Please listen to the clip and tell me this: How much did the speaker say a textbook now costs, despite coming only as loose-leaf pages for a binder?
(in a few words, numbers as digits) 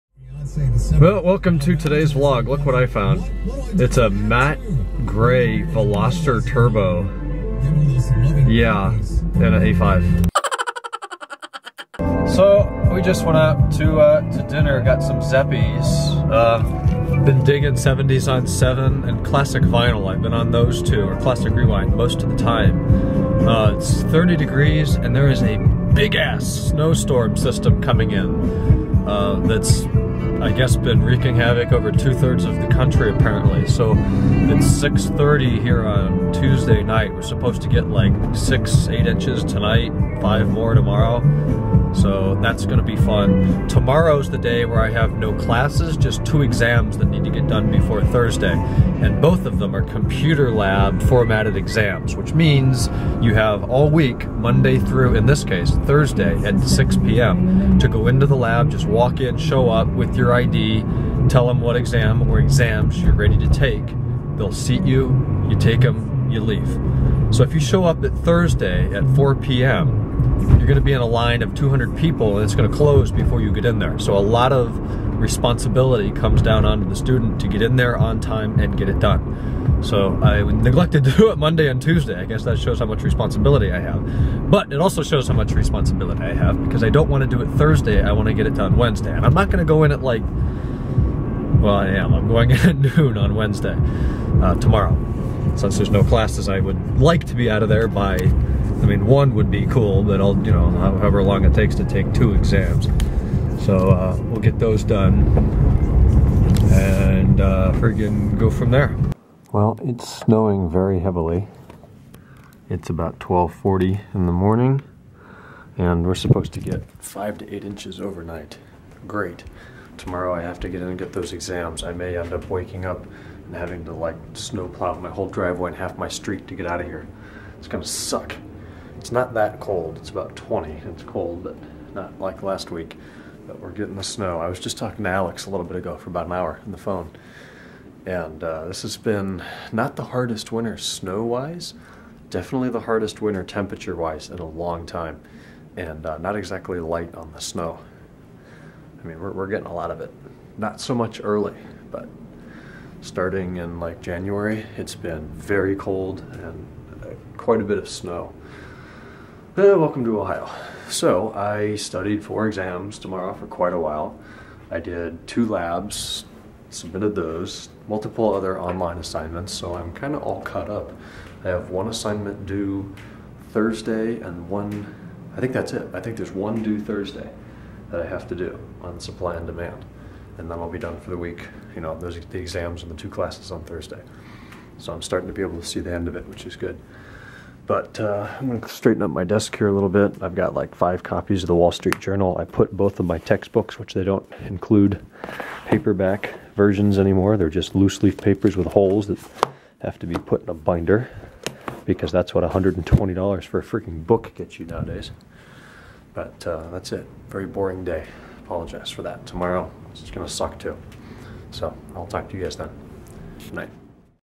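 $120.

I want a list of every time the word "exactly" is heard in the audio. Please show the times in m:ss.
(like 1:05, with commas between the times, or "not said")
2:26.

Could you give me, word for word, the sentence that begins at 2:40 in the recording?
So I studied four exams tomorrow for quite a while.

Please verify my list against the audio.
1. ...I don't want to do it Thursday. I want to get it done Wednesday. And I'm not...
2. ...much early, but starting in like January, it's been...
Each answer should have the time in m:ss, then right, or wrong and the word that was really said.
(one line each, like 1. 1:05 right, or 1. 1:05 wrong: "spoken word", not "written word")
1. 1:26 right
2. 2:30 right.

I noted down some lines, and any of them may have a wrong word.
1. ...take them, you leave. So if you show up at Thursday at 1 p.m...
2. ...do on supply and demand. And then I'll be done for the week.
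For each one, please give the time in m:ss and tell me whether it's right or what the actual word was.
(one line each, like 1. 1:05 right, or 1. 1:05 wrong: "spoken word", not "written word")
1. 1:05 wrong: "4", not "1"
2. 2:58 right.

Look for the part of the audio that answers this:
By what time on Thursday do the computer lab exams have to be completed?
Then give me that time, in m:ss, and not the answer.
0:56.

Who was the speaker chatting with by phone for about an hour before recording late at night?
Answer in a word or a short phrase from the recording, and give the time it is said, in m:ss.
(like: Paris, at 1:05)
Alex, at 2:15.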